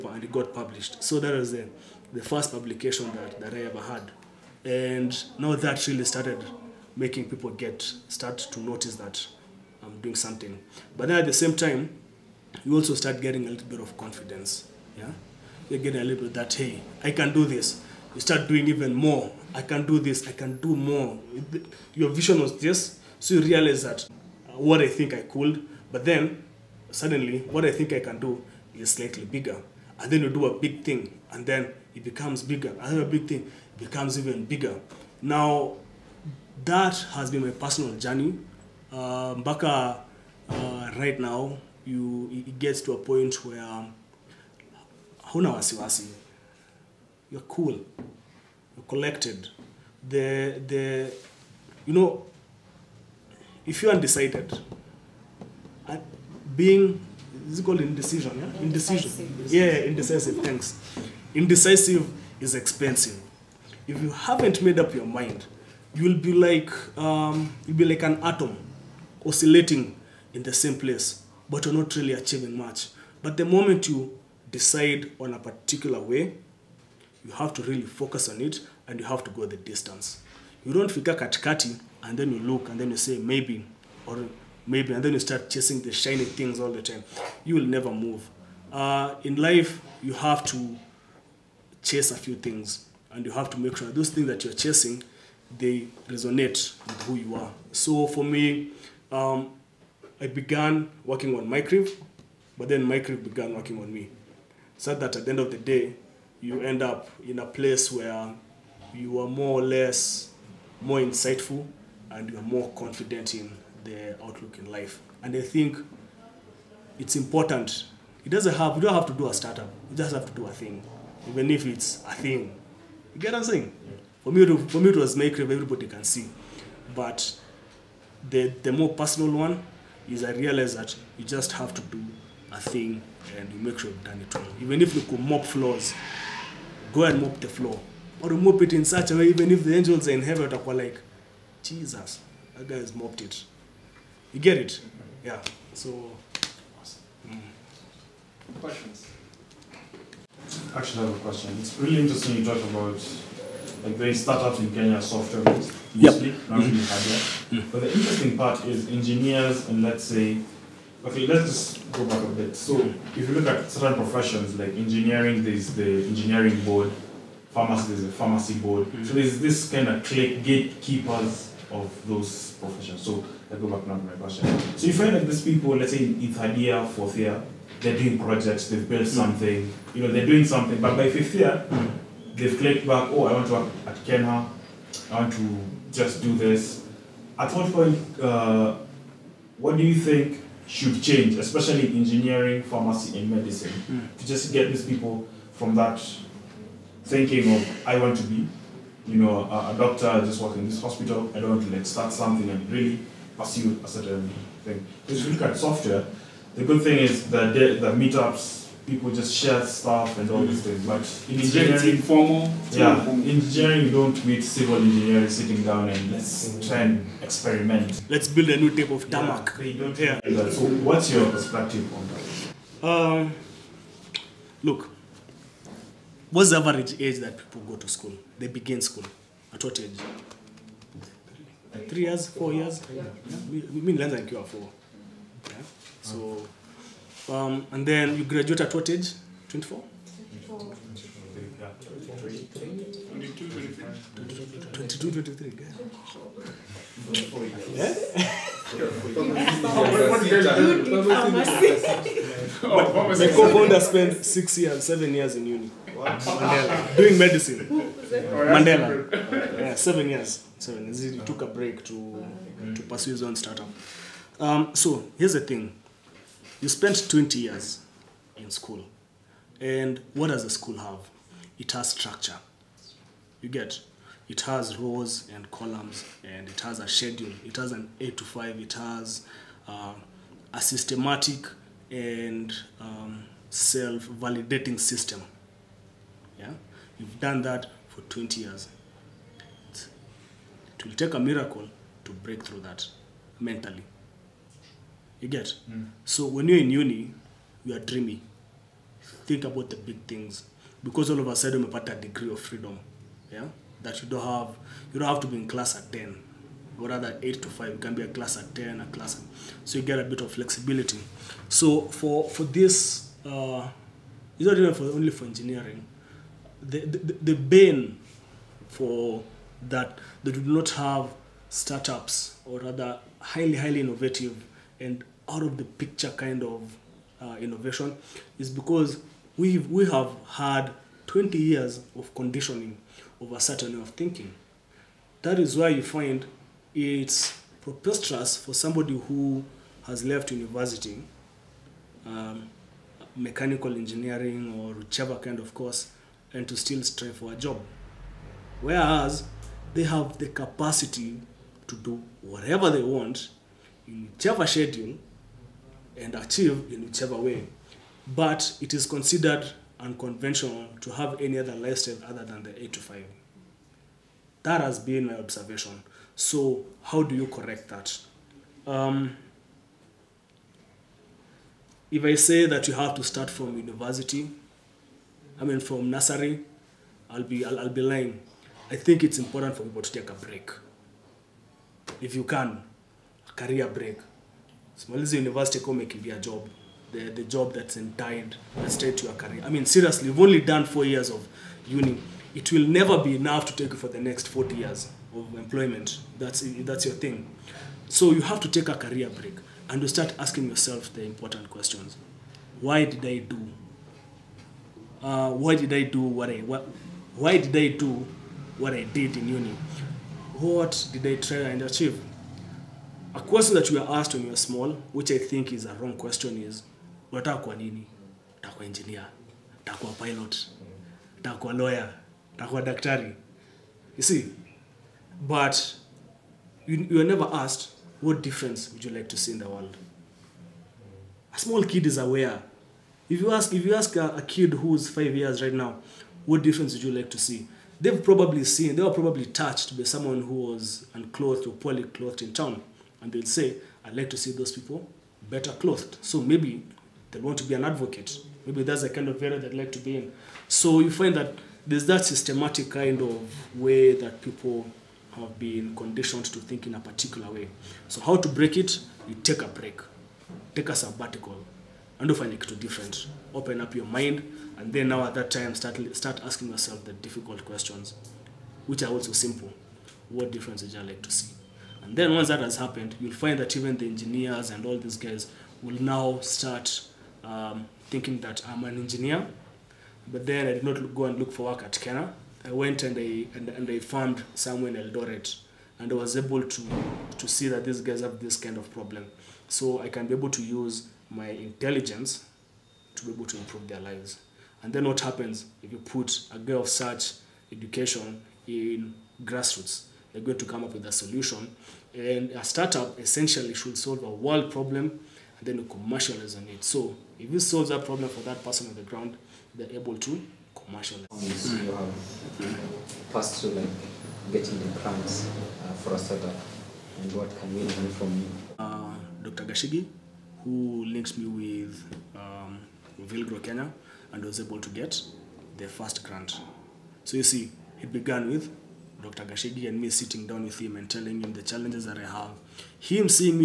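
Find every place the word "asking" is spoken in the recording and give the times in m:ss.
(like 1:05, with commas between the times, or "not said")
6:40, 7:46.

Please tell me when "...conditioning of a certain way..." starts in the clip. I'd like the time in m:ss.
5:32.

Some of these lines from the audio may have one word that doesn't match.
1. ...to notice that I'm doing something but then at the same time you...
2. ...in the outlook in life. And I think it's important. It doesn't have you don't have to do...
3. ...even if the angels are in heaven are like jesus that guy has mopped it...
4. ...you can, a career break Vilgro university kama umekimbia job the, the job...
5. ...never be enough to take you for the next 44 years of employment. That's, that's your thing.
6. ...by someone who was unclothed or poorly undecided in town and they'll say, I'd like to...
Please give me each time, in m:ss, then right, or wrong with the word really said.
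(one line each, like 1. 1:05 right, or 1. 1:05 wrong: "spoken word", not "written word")
1. 0:08 right
2. 1:53 right
3. 2:19 right
4. 6:22 wrong: "Maliza", not "Vilgro"
5. 6:32 wrong: "40", not "44"
6. 7:19 wrong: "clothed", not "undecided".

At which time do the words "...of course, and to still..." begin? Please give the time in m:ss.
5:45.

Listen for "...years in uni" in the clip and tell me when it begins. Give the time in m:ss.
4:15.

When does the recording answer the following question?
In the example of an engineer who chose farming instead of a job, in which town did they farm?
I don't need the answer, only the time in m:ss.
8:04.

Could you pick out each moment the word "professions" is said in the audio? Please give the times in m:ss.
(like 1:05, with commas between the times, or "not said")
2:43, 2:52.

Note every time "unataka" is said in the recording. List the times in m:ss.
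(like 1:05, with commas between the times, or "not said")
6:57.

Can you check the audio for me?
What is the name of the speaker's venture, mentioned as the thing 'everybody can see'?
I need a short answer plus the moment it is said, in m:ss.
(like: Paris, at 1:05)
Micrive, at 2:05.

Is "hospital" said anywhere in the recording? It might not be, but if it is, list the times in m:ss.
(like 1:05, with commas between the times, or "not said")
3:20.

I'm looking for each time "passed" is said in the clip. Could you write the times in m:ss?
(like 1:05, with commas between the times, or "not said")
8:33.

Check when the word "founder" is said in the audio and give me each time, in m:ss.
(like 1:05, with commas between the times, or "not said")
4:13.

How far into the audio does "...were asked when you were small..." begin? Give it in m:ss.
6:53.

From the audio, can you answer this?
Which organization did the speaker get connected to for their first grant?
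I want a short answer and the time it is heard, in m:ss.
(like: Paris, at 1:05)
Vilgro Kenya, at 8:43.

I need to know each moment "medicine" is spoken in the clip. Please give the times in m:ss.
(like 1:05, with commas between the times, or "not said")
3:13, 4:17.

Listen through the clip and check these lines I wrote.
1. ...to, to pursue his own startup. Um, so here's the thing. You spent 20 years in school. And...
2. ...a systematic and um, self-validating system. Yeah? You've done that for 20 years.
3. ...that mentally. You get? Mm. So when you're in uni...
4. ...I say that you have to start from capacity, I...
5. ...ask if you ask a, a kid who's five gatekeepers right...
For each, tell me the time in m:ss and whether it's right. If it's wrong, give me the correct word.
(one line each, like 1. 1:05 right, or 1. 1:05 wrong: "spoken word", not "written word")
1. 4:21 right
2. 4:40 right
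3. 4:52 right
4. 6:12 wrong: "university", not "capacity"
5. 7:13 wrong: "years", not "gatekeepers".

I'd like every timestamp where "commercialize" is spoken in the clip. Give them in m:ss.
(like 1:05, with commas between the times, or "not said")
8:25, 8:30.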